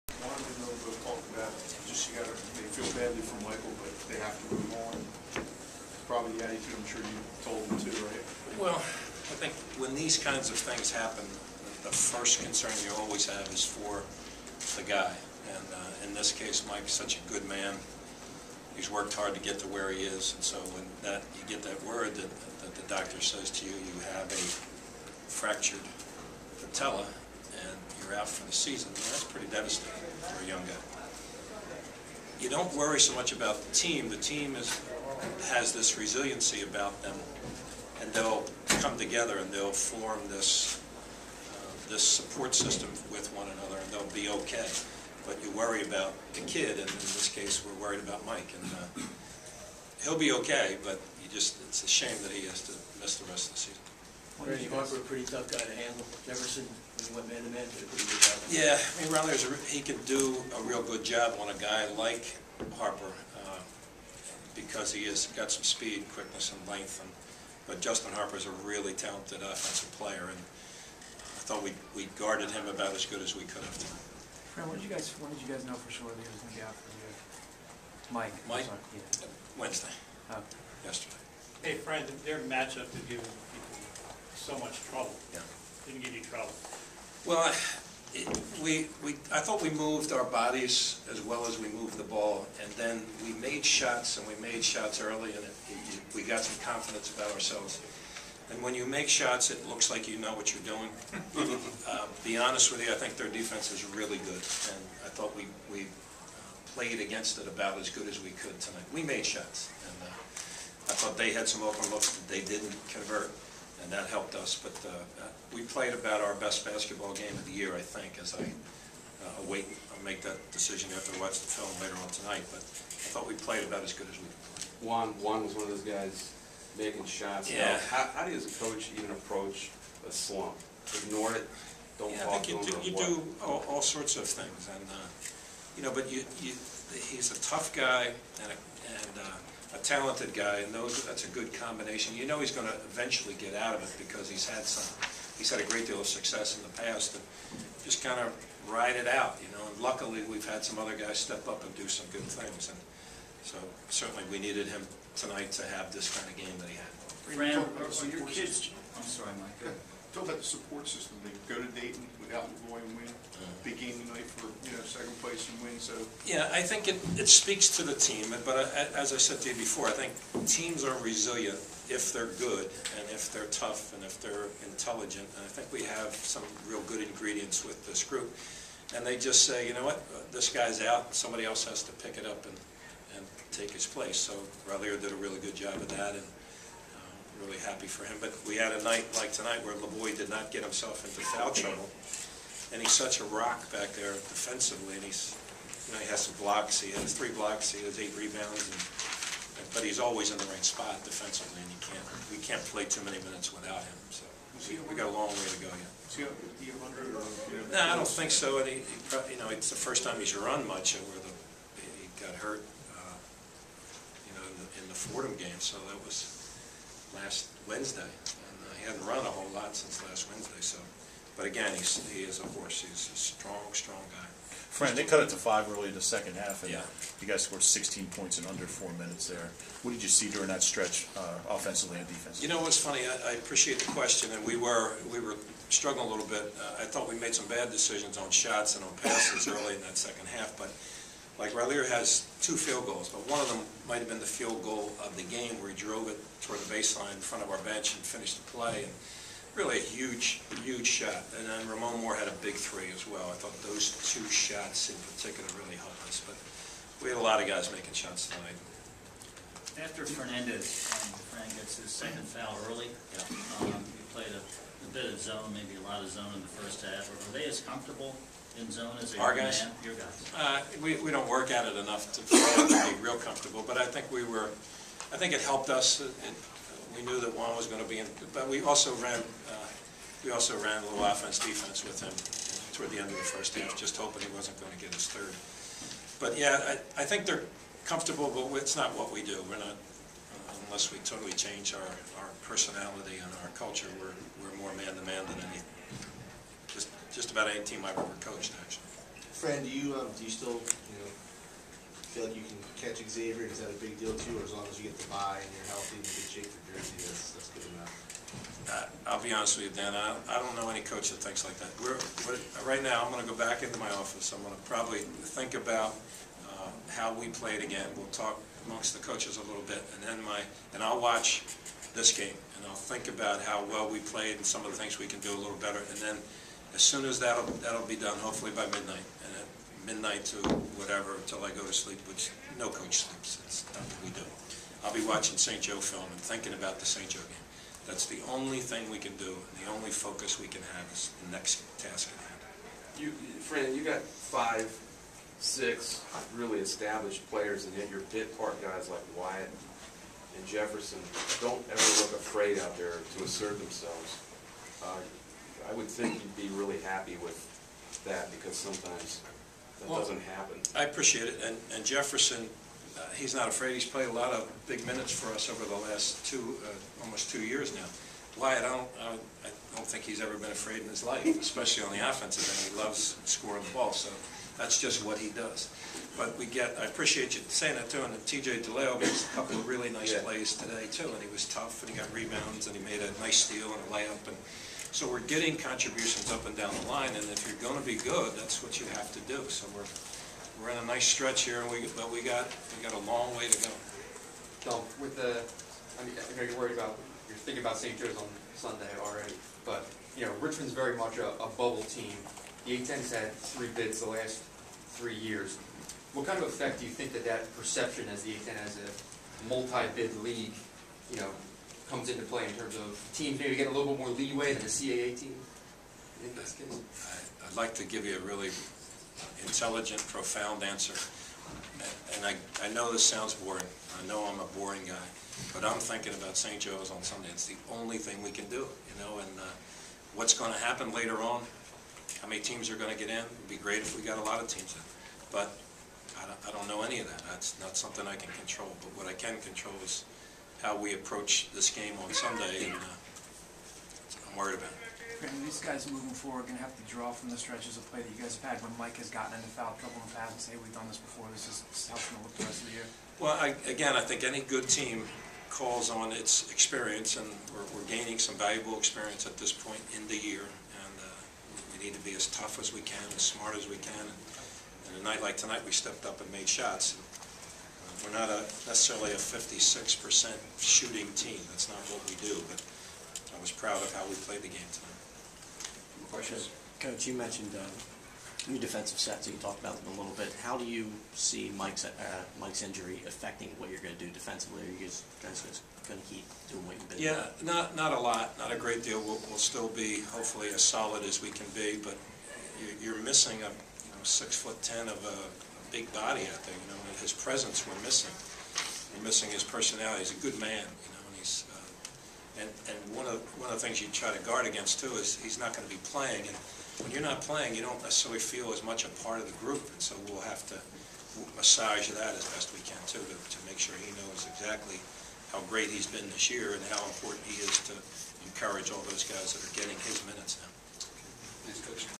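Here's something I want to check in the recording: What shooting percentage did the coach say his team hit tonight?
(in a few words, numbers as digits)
56%.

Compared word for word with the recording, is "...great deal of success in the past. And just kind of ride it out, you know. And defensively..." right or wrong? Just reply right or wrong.
wrong.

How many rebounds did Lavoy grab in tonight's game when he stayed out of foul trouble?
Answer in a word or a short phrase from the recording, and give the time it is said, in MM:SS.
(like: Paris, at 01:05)
8, at 03:18.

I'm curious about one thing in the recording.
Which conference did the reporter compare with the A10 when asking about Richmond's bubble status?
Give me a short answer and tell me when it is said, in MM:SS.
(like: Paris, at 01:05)
CAA, at 06:54.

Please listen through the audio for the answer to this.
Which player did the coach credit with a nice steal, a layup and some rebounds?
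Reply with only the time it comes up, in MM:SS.
06:18.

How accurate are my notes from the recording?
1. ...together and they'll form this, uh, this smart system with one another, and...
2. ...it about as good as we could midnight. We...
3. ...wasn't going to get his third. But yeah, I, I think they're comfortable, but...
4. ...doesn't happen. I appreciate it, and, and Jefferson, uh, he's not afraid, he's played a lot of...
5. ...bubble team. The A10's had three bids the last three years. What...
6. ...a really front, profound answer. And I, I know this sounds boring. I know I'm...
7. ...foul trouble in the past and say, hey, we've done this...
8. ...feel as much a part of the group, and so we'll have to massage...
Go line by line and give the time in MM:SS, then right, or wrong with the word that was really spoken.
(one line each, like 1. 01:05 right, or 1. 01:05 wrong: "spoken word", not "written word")
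1. 00:38 wrong: "support", not "smart"
2. 01:47 wrong: "tonight", not "midnight"
3. 04:44 right
4. 05:59 right
5. 06:41 right
6. 06:58 wrong: "intelligent", not "front"
7. 07:29 right
8. 08:28 right.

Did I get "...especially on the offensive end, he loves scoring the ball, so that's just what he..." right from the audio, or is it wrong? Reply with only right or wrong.
right.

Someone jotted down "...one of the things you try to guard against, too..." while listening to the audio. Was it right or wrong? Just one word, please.
right.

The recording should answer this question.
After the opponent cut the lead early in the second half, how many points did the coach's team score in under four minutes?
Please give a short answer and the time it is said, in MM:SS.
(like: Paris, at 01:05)
16, at 03:47.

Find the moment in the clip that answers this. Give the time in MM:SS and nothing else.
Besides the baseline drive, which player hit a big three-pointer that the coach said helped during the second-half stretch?
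04:11.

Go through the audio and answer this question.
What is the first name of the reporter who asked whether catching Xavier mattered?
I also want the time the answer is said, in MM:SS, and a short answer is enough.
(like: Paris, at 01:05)
Dan, at 05:09.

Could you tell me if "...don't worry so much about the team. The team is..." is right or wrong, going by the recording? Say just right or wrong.
right.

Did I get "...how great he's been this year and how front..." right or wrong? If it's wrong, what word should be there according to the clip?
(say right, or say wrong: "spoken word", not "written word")
wrong: "important", not "front".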